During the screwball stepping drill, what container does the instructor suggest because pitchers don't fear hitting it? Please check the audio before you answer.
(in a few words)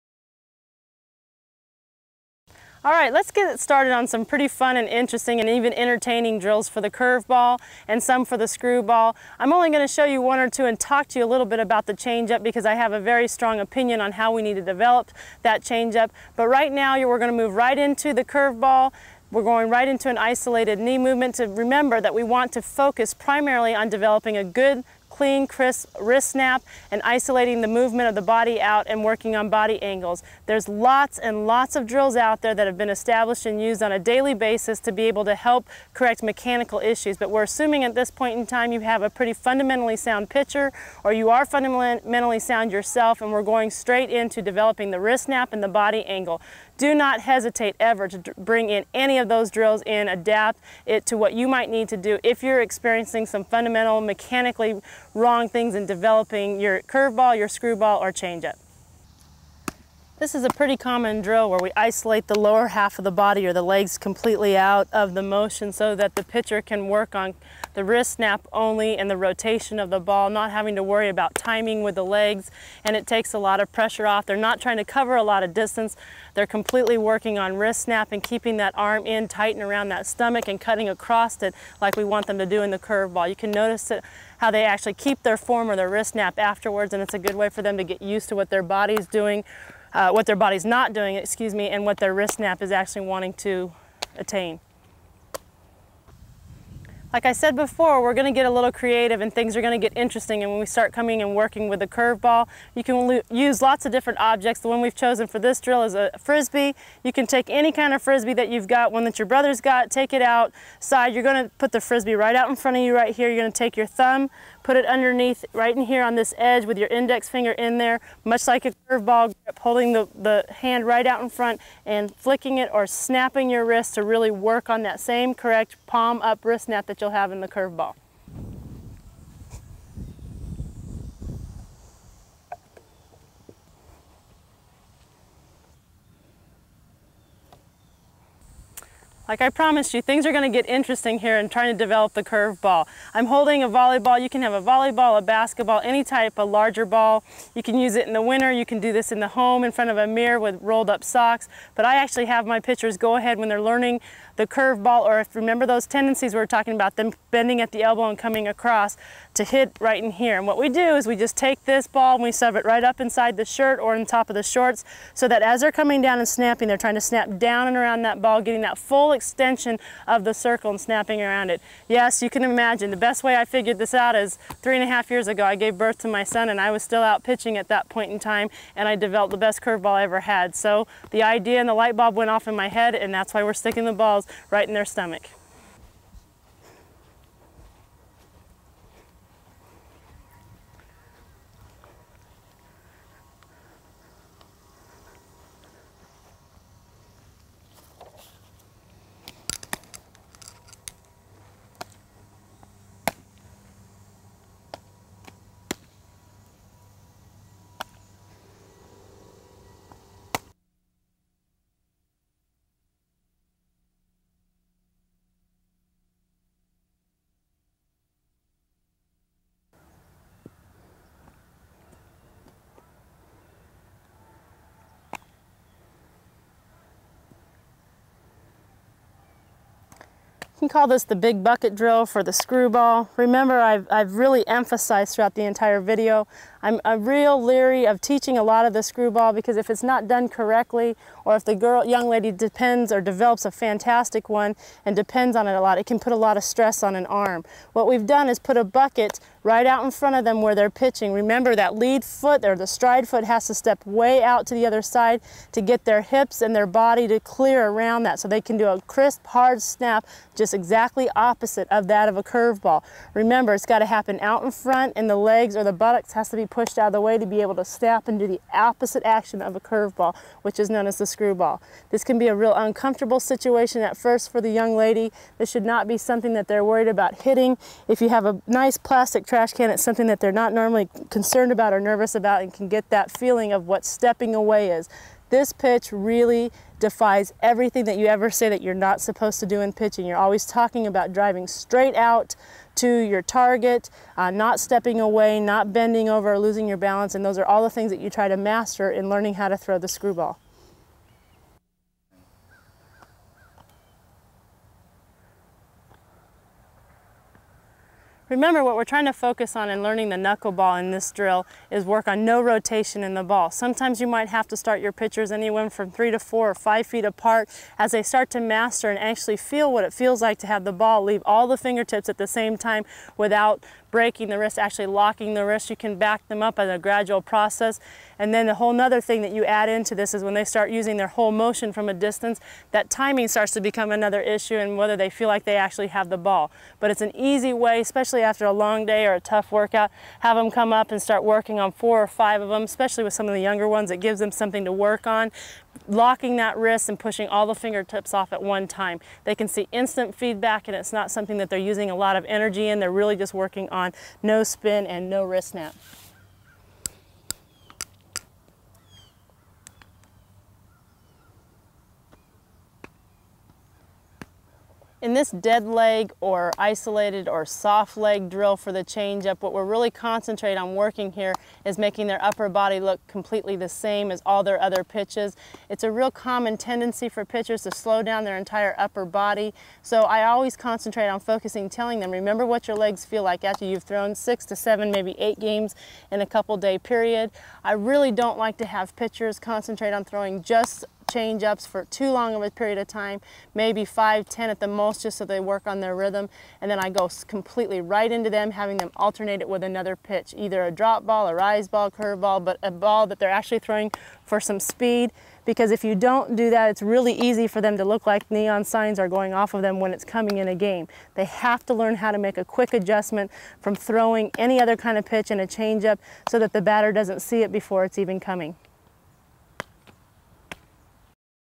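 plastic trash can.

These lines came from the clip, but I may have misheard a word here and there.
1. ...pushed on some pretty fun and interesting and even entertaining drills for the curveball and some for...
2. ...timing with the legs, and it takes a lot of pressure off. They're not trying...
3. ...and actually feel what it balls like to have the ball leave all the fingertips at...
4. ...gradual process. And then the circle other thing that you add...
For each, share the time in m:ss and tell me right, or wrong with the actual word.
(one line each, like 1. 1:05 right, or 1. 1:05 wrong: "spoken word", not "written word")
1. 0:03 wrong: "started", not "pushed"
2. 1:11 right
3. 5:18 wrong: "feels", not "balls"
4. 5:26 wrong: "whole", not "circle".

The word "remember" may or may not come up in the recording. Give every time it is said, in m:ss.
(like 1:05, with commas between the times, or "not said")
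0:21, 2:35, 3:53, 4:11, 4:23, 5:08, 6:22.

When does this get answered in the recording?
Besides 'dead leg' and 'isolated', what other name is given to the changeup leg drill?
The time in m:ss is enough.
6:07.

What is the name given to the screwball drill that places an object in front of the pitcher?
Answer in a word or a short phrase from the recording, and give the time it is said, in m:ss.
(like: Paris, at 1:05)
big bucket drill, at 3:51.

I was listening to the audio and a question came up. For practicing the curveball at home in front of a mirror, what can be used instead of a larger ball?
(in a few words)
rolled up socks.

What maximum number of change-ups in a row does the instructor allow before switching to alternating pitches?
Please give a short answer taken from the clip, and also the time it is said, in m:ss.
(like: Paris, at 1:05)
10, at 6:34.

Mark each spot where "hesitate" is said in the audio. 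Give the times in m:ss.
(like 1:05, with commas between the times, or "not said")
0:47.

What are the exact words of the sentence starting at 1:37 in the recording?
Like I said before, we're going to get a little creative and things are going to get interesting.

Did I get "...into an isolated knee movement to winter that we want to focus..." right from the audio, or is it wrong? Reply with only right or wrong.
wrong.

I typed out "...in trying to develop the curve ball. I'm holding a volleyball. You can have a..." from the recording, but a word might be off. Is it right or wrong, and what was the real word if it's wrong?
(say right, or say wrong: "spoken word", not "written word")
right.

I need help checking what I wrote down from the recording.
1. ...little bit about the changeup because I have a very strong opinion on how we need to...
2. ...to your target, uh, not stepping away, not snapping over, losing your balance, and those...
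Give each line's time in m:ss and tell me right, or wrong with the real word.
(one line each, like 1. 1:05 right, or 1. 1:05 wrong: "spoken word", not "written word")
1. 0:11 right
2. 4:52 wrong: "bending", not "snapping".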